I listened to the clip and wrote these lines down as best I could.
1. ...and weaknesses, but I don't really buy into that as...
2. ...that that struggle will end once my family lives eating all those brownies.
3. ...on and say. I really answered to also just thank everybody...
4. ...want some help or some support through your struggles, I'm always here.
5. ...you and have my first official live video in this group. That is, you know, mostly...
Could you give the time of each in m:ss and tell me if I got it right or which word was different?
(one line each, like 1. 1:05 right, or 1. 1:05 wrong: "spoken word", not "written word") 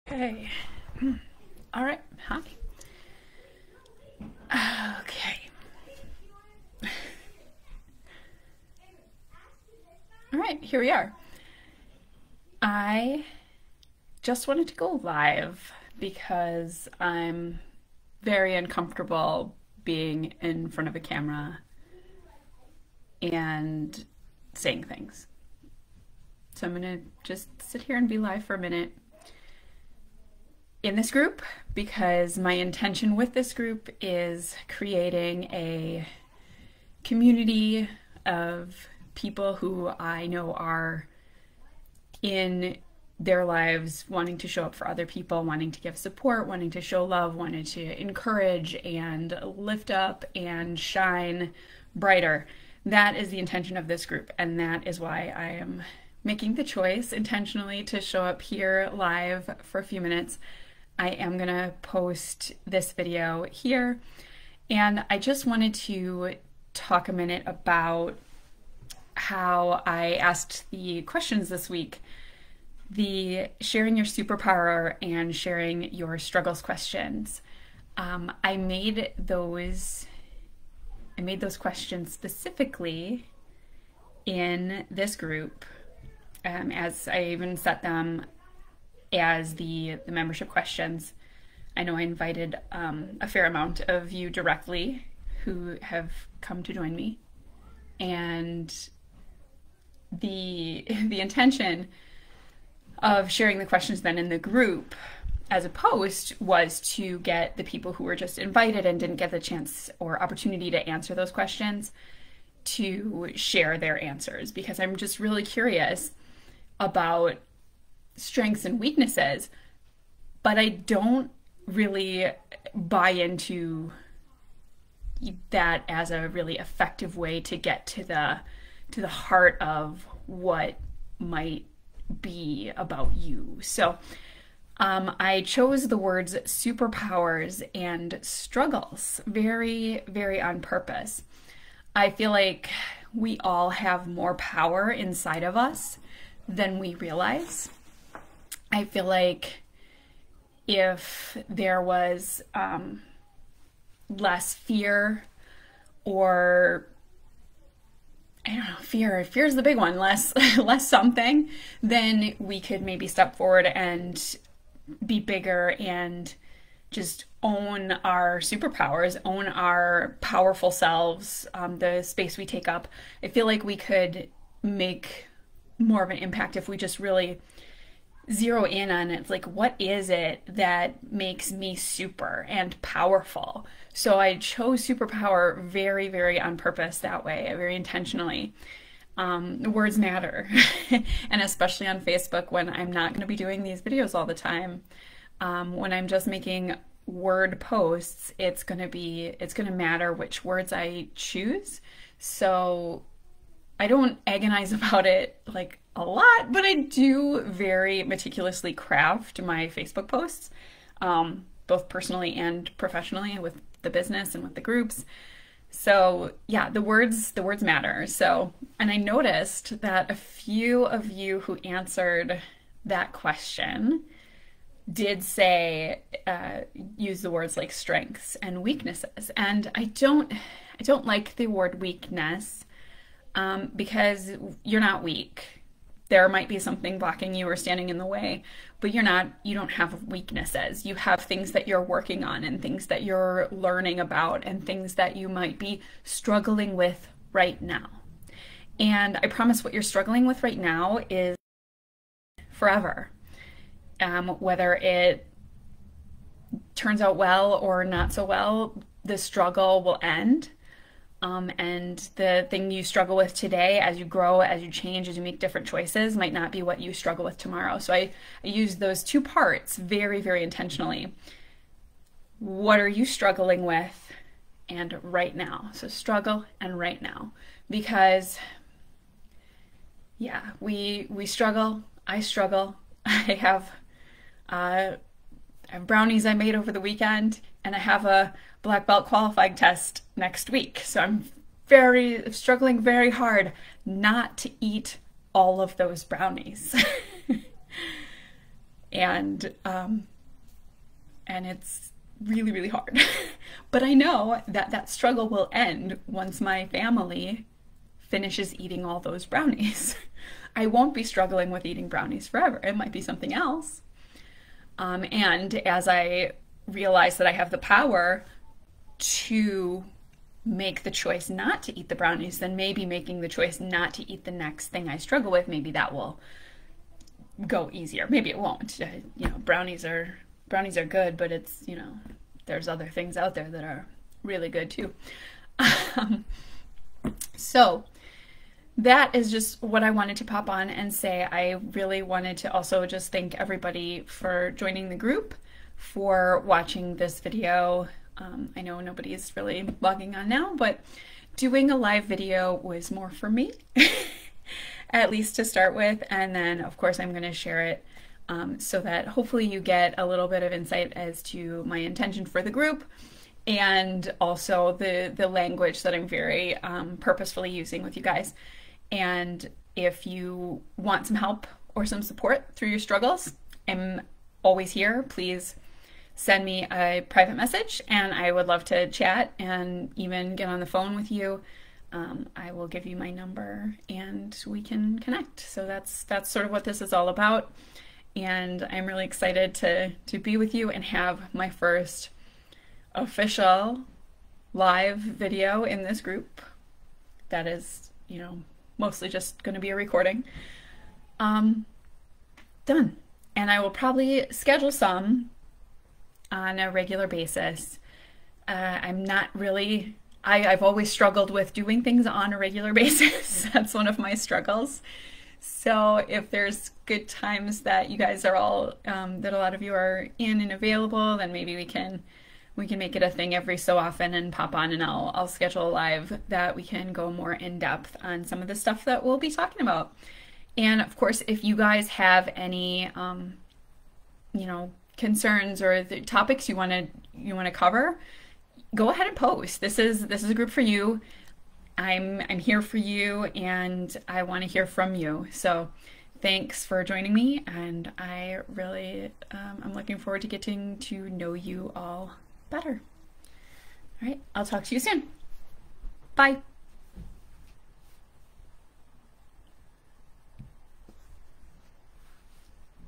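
1. 1:58 right
2. 5:04 wrong: "finishes", not "lives"
3. 5:40 wrong: "wanted", not "answered"
4. 6:10 right
5. 6:30 right.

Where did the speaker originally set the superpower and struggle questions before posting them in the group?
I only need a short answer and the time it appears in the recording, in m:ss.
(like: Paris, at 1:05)
membership questions, at 1:30.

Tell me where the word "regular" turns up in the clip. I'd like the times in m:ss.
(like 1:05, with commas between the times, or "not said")
6:46, 6:52.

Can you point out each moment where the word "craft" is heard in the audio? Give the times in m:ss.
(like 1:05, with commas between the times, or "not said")
3:28.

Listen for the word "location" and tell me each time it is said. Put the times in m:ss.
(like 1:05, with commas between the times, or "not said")
not said.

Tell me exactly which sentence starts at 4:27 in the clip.
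So I, I use those two parts very, very intentionally.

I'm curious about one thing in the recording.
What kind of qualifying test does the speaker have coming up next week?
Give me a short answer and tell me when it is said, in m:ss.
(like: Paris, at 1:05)
black belt, at 4:48.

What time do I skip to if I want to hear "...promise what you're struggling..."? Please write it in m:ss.
4:09.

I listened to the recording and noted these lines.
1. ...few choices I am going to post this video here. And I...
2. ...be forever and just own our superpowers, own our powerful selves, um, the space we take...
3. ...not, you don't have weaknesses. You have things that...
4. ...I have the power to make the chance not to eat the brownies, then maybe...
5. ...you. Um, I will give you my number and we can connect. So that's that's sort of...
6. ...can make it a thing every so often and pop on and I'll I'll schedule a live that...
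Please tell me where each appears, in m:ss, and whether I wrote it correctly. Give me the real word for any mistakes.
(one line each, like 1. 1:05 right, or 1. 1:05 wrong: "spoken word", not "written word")
1. 0:59 wrong: "minutes", not "choices"
2. 2:45 wrong: "bigger", not "forever"
3. 3:59 right
4. 5:17 wrong: "choice", not "chance"
5. 6:21 right
6. 7:02 right.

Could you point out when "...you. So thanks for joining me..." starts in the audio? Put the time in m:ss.
7:24.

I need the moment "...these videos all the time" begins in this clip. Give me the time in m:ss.
3:13.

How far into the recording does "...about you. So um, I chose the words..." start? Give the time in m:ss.
2:12.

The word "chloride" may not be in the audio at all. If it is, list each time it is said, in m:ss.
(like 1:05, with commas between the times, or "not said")
not said.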